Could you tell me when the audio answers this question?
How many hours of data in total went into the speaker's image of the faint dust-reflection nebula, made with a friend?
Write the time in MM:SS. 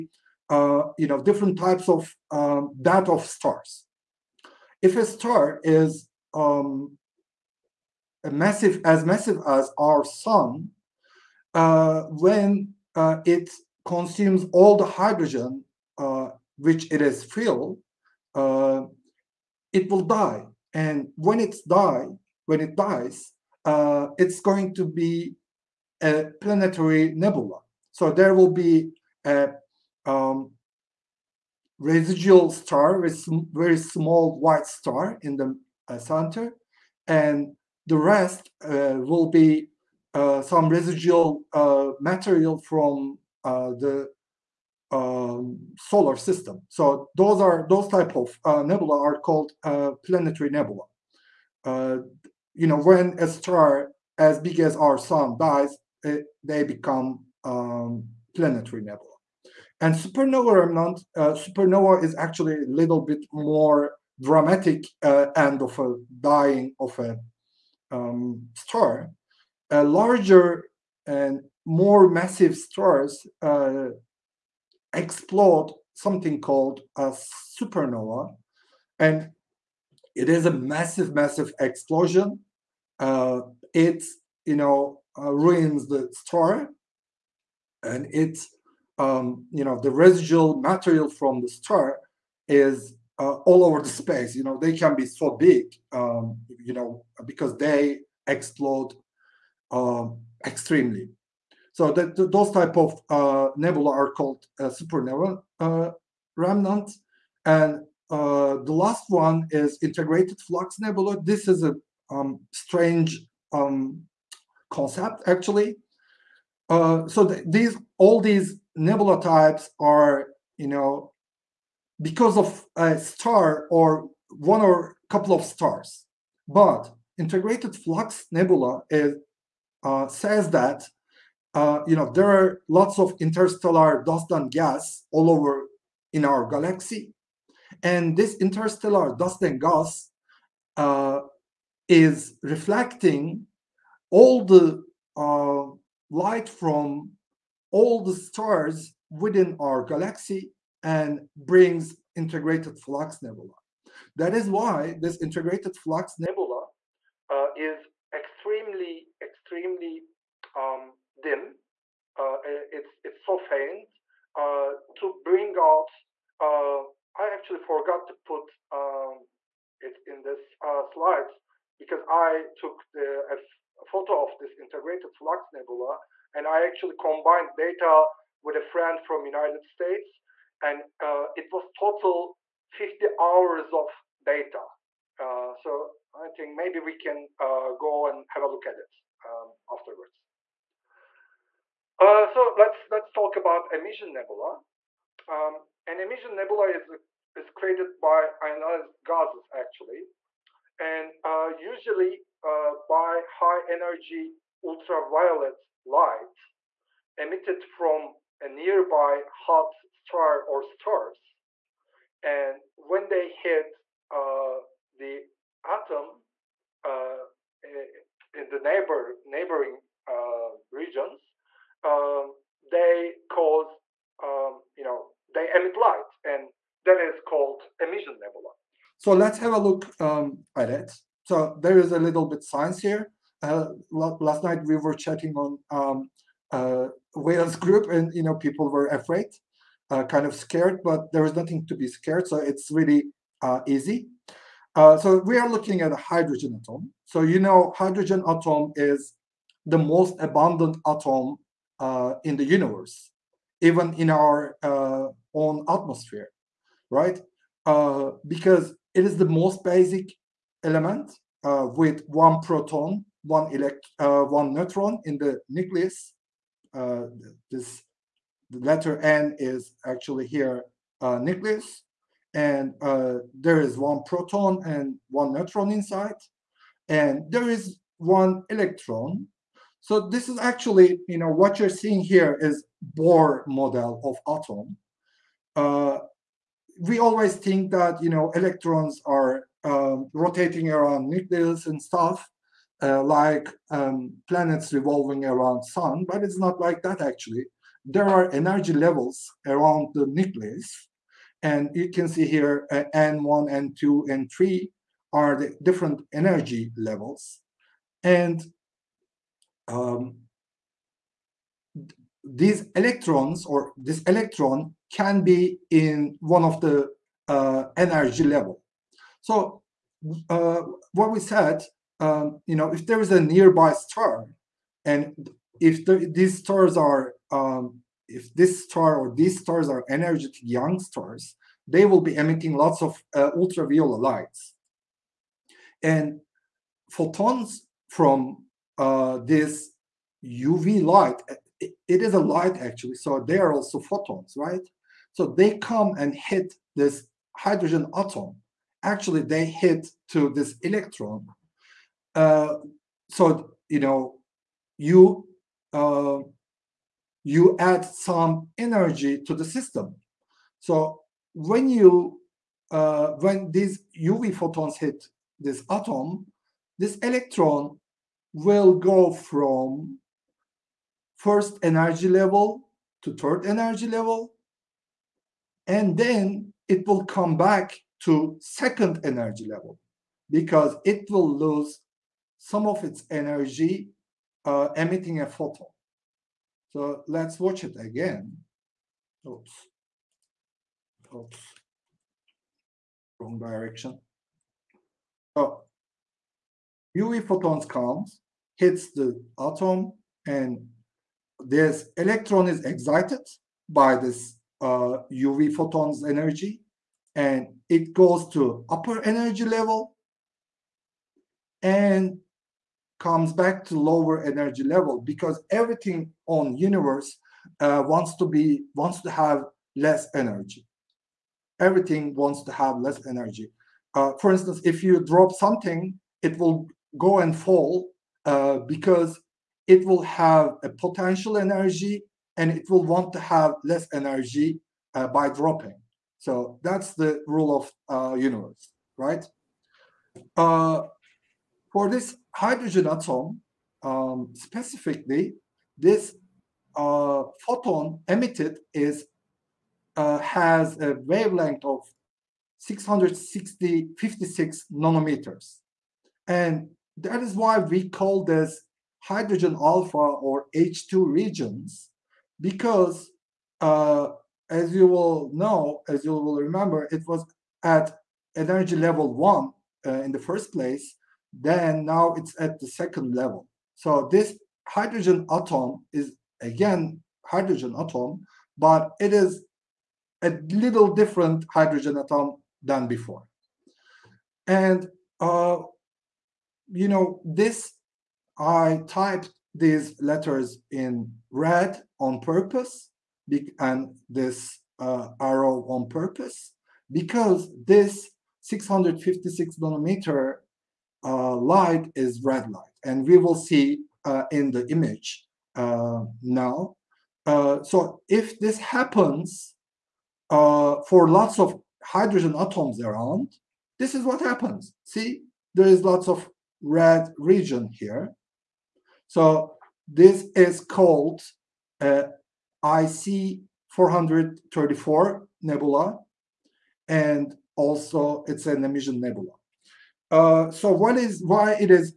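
03:02.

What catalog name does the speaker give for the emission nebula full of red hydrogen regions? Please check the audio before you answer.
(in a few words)
IC 434.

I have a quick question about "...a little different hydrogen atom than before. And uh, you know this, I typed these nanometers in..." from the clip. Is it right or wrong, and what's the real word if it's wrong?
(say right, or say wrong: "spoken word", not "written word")
wrong: "letters", not "nanometers".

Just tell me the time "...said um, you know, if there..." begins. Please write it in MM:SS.
05:21.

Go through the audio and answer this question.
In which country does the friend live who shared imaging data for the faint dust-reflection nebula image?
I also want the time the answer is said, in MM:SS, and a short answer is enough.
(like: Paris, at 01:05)
United States, at 02:59.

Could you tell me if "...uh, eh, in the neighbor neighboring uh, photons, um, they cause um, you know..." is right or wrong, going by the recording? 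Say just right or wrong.
wrong.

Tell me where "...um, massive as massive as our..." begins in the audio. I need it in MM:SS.
00:06.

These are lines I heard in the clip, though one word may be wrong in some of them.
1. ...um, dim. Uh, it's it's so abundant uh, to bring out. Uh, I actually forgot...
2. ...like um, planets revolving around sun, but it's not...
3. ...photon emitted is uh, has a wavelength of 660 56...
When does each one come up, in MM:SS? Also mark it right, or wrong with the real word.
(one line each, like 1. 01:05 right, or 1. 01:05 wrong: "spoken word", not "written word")
1. 02:40 wrong: "faint", not "abundant"
2. 04:53 right
3. 07:27 right.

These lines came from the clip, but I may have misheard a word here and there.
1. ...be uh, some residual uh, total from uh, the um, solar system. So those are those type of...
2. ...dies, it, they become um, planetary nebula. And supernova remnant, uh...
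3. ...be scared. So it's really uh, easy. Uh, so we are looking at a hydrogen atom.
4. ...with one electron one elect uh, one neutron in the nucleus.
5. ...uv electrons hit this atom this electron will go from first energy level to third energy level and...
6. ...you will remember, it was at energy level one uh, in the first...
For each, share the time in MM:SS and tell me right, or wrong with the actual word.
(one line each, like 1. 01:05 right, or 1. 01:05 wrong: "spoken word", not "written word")
1. 00:39 wrong: "material", not "total"
2. 00:55 right
3. 04:01 right
4. 04:21 wrong: "proton", not "electron"
5. 06:04 wrong: "photons", not "electrons"
6. 07:46 right.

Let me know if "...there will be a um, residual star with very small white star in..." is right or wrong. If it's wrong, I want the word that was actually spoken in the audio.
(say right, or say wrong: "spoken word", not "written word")
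right.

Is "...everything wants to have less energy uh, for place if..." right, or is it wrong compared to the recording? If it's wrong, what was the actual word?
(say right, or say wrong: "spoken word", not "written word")
wrong: "instance", not "place".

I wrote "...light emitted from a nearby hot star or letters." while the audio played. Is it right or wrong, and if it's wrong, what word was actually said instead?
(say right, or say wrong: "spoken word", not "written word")
wrong: "stars", not "letters".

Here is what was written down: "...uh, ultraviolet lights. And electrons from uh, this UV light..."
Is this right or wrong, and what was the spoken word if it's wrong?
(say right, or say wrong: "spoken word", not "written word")
wrong: "photons", not "electrons".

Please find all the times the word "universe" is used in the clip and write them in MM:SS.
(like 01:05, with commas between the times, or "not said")
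04:12, 06:56, 07:18.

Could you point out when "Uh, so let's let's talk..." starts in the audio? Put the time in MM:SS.
03:11.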